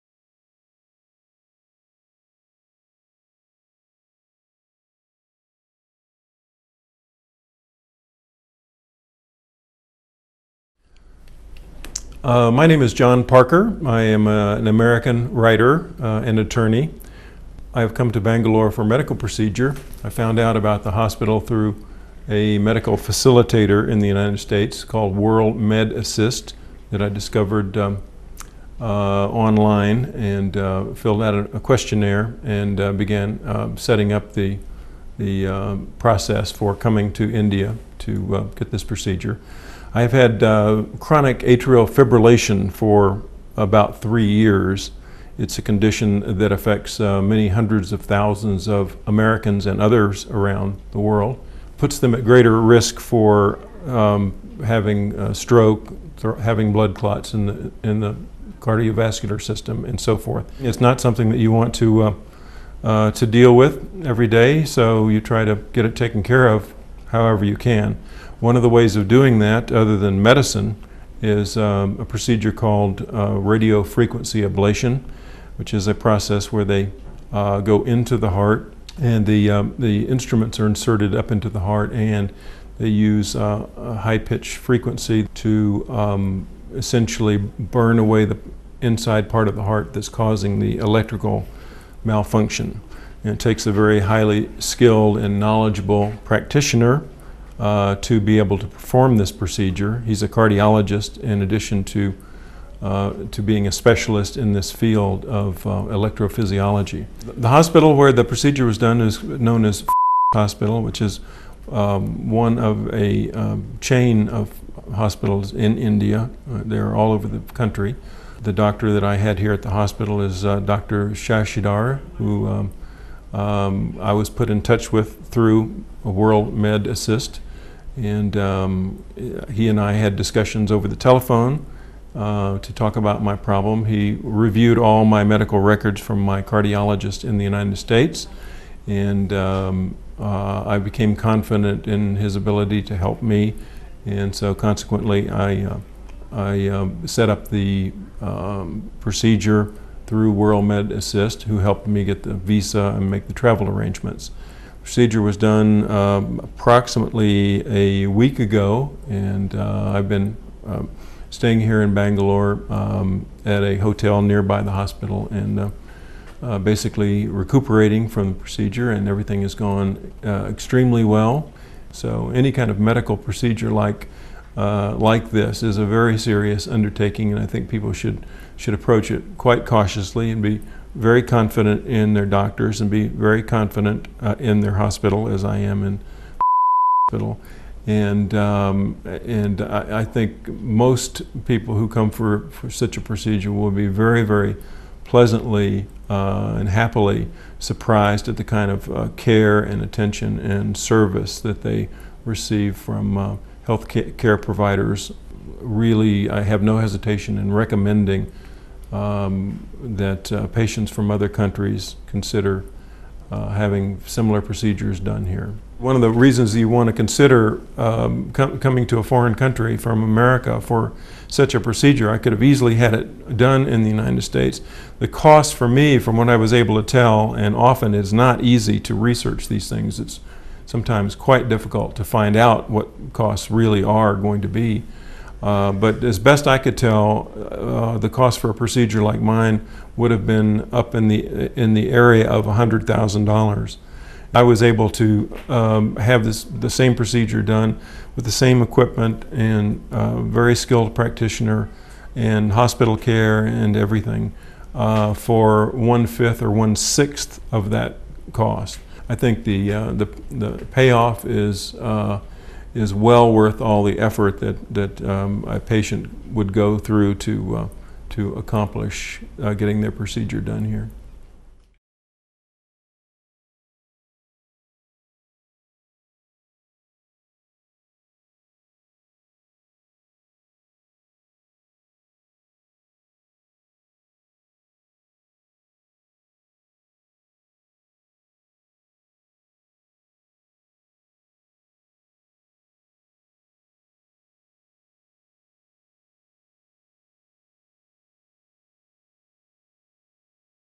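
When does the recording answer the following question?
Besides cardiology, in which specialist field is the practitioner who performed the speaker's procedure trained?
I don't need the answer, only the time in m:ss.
1:45.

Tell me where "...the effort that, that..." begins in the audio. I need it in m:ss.
4:23.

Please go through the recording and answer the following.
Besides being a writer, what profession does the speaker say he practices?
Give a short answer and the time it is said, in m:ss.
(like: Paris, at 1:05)
attorney, at 0:16.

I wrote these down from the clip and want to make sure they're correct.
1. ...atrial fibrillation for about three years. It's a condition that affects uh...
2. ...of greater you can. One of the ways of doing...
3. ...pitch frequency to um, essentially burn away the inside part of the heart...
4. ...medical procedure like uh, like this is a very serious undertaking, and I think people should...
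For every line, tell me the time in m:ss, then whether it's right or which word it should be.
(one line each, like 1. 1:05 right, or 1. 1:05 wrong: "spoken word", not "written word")
1. 0:41 right
2. 1:06 wrong: "however", not "greater"
3. 1:24 right
4. 2:52 right.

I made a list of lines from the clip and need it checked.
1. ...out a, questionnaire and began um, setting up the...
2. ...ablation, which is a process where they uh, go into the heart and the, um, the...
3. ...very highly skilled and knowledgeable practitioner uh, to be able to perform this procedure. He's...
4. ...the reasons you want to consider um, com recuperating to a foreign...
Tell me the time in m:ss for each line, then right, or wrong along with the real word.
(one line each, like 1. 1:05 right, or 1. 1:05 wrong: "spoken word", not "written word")
1. 0:31 right
2. 1:14 right
3. 1:33 right
4. 3:36 wrong: "coming", not "recuperating".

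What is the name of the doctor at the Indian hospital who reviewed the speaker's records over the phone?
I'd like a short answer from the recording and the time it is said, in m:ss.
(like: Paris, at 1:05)
Dr. Shashidhar, at 2:00.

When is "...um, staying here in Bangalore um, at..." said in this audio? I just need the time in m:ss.
2:40.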